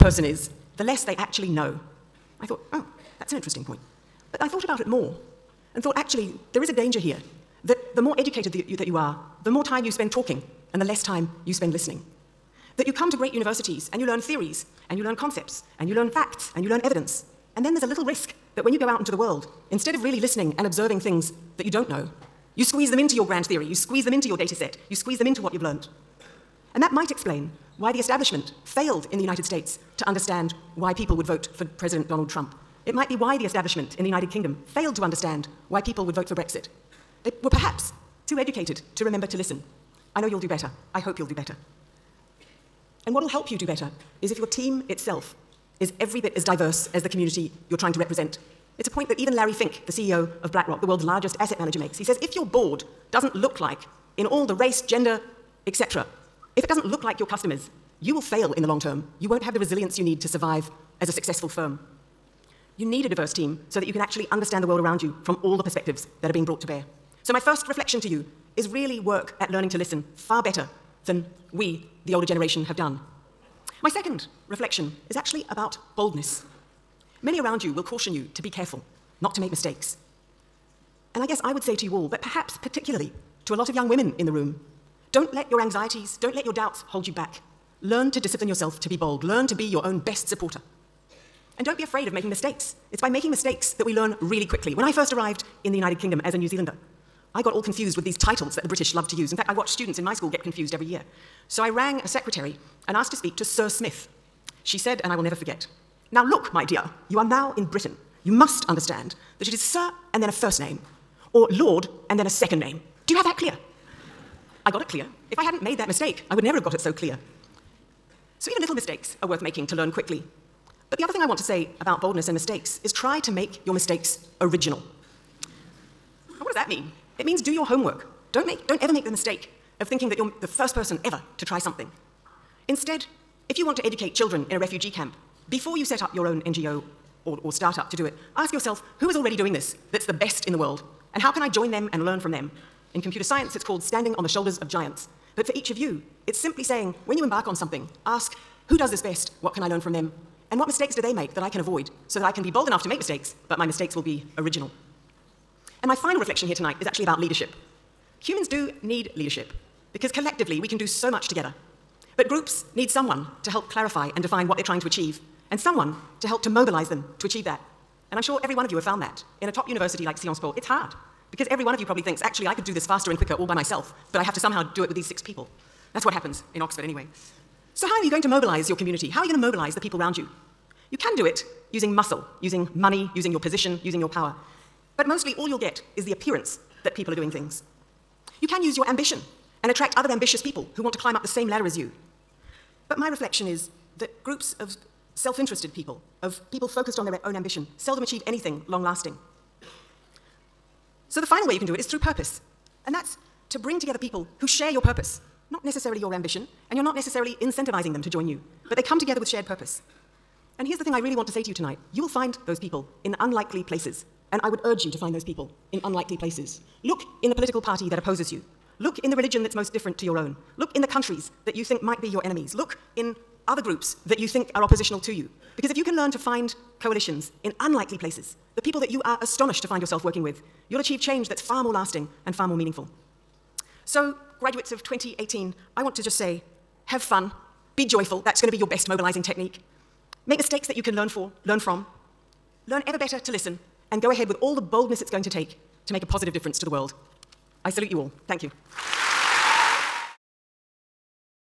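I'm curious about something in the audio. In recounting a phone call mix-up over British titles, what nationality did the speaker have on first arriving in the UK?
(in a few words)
New Zealander.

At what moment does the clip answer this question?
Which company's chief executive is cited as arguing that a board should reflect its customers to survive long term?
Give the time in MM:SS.
00:50.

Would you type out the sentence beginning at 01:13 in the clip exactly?
My second reflection is actually about boldness.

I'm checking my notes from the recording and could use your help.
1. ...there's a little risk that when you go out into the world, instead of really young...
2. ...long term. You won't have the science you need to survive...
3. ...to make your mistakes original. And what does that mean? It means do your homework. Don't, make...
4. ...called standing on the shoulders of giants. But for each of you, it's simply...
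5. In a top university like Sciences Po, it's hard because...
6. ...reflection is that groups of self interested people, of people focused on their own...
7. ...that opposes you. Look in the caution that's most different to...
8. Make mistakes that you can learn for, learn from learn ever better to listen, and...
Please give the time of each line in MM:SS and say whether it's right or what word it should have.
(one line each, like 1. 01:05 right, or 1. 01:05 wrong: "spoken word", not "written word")
1. 00:17 wrong: "listening", not "young"
2. 00:58 wrong: "resilience", not "science"
3. 02:03 right
4. 02:23 right
5. 02:49 right
6. 03:13 right
7. 03:37 wrong: "religion", not "caution"
8. 04:00 right.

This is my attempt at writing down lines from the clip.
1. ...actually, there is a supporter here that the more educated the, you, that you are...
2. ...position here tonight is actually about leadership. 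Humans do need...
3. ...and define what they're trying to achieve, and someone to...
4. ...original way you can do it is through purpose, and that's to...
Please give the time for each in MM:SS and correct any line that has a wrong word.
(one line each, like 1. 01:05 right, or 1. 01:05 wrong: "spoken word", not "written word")
1. 00:05 wrong: "danger", not "supporter"
2. 02:36 wrong: "reflection", not "position"
3. 02:44 right
4. 03:21 wrong: "final", not "original".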